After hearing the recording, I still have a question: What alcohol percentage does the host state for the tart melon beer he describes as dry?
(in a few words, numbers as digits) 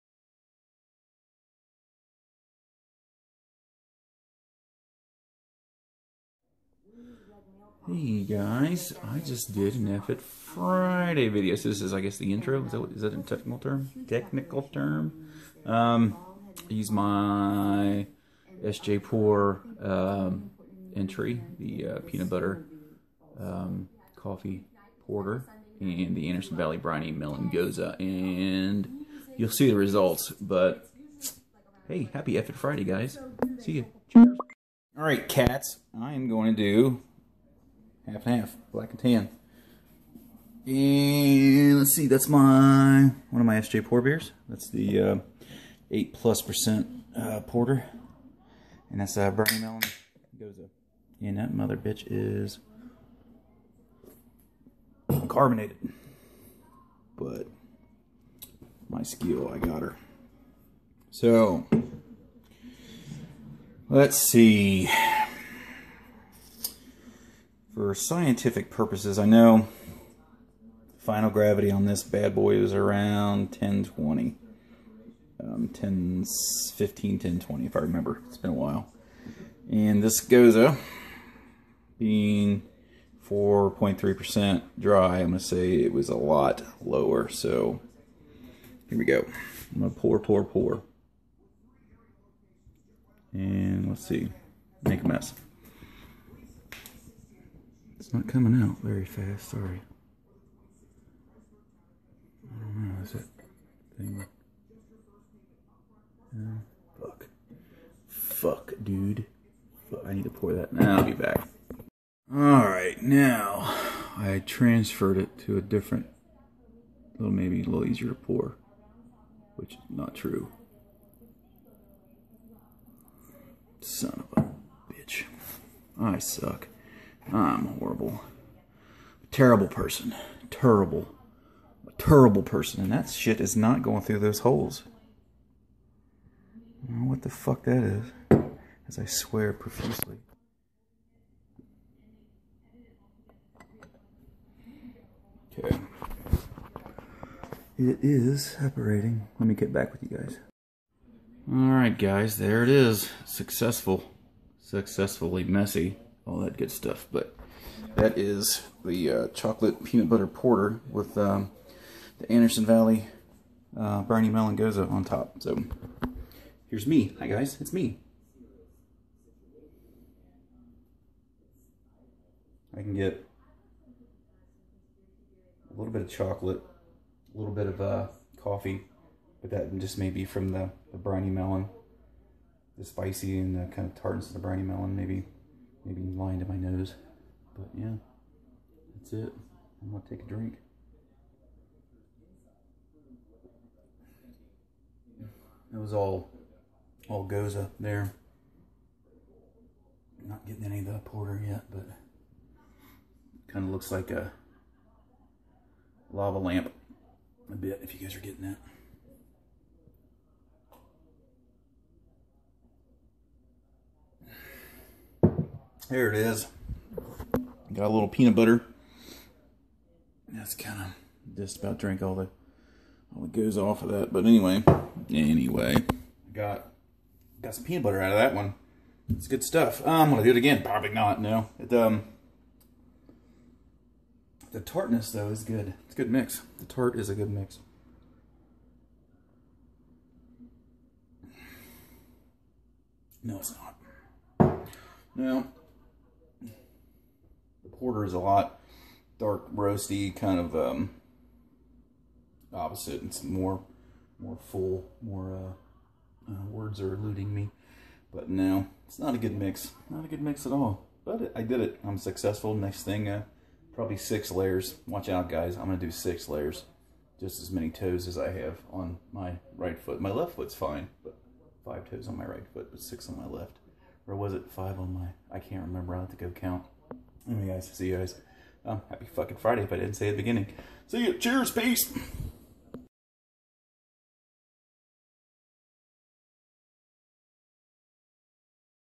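4.3%.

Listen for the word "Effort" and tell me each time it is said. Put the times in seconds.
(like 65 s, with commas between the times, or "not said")
9 s, 32 s.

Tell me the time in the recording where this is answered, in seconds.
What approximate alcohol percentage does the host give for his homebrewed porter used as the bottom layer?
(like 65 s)
45 s.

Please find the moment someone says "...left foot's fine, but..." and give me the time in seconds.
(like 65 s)
270 s.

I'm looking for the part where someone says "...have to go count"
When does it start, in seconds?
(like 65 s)
276 s.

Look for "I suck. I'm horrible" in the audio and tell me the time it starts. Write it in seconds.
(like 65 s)
125 s.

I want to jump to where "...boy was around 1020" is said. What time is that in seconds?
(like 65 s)
72 s.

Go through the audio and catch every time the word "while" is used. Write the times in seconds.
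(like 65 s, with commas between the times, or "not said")
78 s.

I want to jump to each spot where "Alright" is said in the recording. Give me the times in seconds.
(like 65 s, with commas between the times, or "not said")
112 s.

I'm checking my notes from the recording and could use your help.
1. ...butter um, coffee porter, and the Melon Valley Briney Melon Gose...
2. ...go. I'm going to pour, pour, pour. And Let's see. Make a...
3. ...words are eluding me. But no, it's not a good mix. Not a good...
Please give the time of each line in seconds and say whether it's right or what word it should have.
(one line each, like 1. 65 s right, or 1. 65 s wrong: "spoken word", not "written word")
1. 22 s wrong: "Anderson", not "Melon"
2. 89 s right
3. 256 s right.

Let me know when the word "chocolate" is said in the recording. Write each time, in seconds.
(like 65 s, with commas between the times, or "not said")
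159 s, 176 s.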